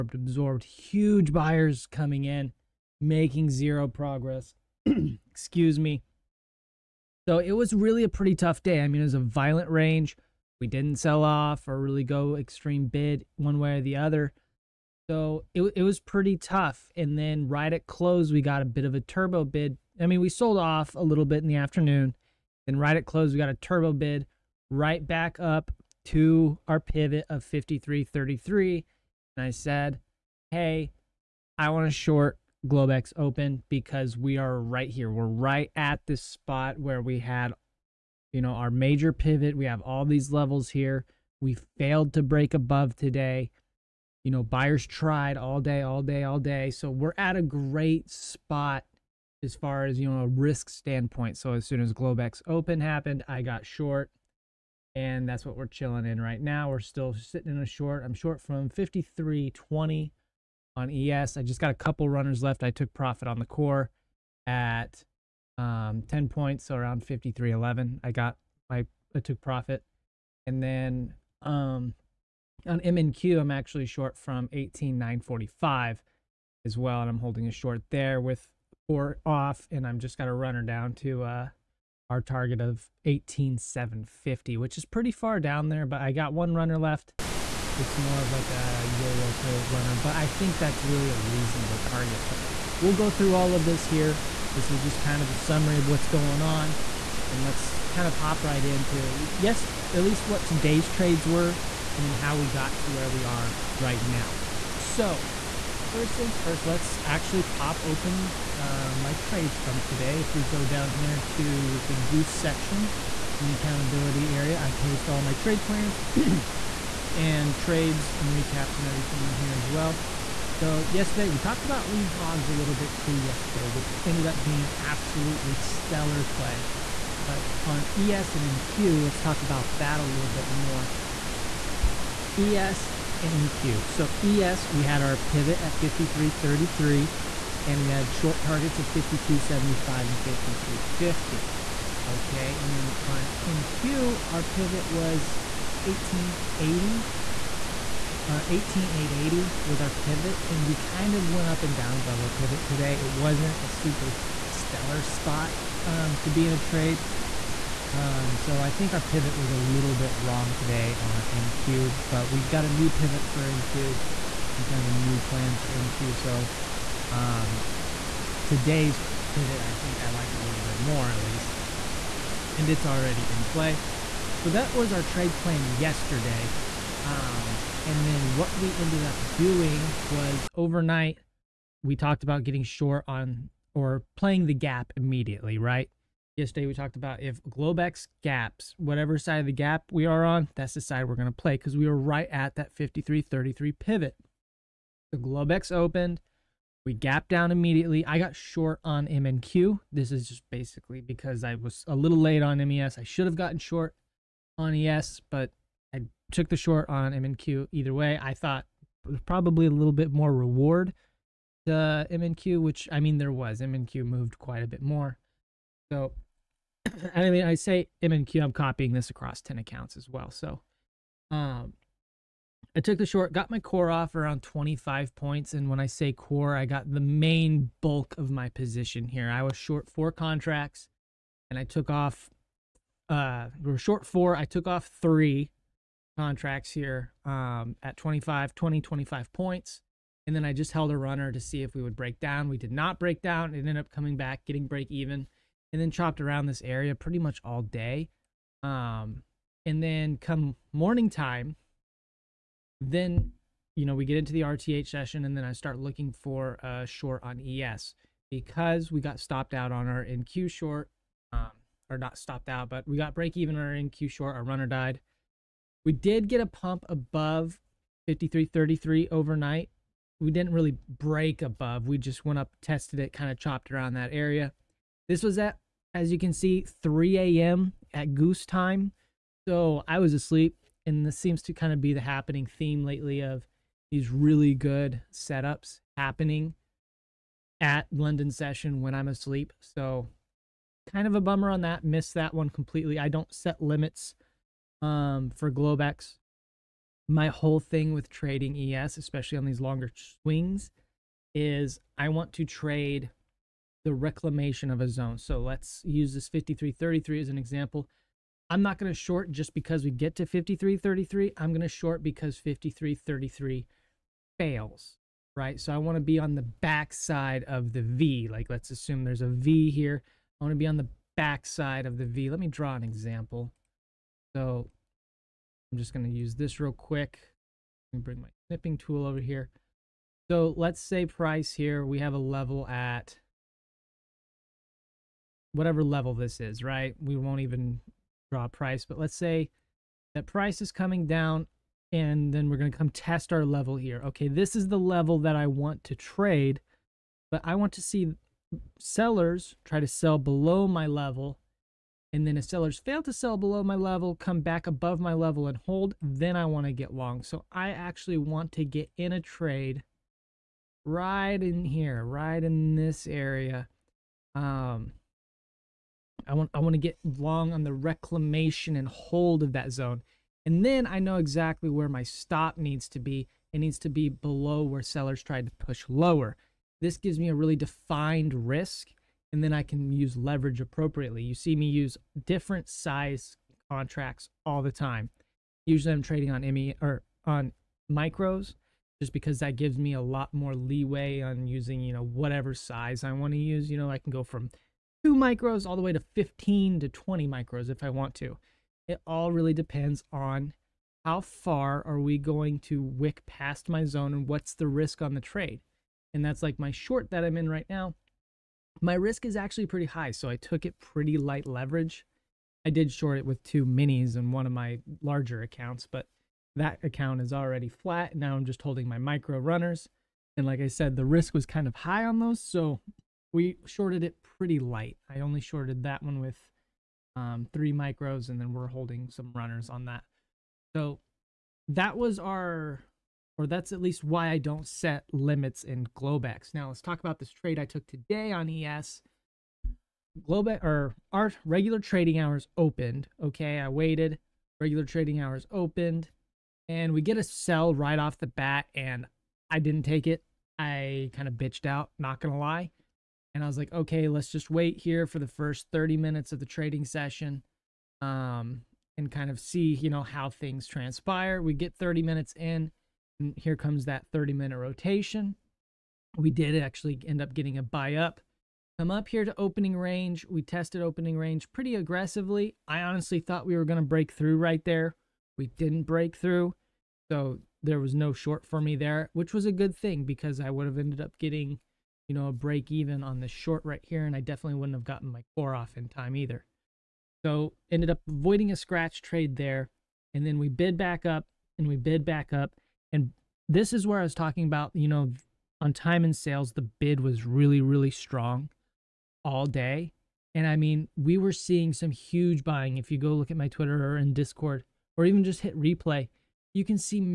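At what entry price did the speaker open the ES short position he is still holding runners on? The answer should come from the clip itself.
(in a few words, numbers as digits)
53.20.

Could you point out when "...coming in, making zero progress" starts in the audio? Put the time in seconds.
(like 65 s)
1 s.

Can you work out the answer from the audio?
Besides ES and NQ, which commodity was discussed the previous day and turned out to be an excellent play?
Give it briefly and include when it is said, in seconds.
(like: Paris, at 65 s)
lean hogs, at 121 s.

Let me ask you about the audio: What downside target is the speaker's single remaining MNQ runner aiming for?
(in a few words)
18,750.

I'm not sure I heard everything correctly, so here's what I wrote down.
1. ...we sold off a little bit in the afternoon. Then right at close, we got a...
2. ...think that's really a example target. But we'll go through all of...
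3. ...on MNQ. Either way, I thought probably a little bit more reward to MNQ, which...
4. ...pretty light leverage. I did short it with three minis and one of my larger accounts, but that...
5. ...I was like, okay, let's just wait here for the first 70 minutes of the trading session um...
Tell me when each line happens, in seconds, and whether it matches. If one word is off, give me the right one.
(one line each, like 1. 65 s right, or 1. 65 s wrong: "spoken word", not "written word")
1. 20 s right
2. 90 s wrong: "reasonable", not "example"
3. 206 s right
4. 410 s wrong: "two", not "three"
5. 453 s wrong: "30", not "70".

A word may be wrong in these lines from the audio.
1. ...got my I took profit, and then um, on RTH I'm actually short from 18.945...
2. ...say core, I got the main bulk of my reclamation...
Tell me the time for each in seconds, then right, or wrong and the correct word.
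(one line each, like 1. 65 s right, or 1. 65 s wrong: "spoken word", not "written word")
1. 68 s wrong: "MNQ", not "RTH"
2. 225 s wrong: "position", not "reclamation".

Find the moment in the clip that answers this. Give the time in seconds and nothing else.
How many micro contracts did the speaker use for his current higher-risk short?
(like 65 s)
427 s.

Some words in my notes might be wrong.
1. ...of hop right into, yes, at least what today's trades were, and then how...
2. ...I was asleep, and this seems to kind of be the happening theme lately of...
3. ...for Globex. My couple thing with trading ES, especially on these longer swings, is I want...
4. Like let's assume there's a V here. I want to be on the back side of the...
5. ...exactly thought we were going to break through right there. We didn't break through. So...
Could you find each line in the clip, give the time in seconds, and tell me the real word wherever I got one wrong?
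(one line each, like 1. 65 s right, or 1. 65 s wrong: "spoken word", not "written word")
1. 98 s right
2. 279 s right
3. 295 s wrong: "whole", not "couple"
4. 318 s right
5. 472 s wrong: "honestly", not "exactly".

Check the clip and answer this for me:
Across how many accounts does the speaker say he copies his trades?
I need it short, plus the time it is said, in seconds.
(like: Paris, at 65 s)
10, at 219 s.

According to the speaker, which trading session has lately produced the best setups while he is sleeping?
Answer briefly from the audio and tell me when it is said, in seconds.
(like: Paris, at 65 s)
London session, at 287 s.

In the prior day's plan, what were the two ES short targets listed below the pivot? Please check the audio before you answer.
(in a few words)
52.75 and 52.50.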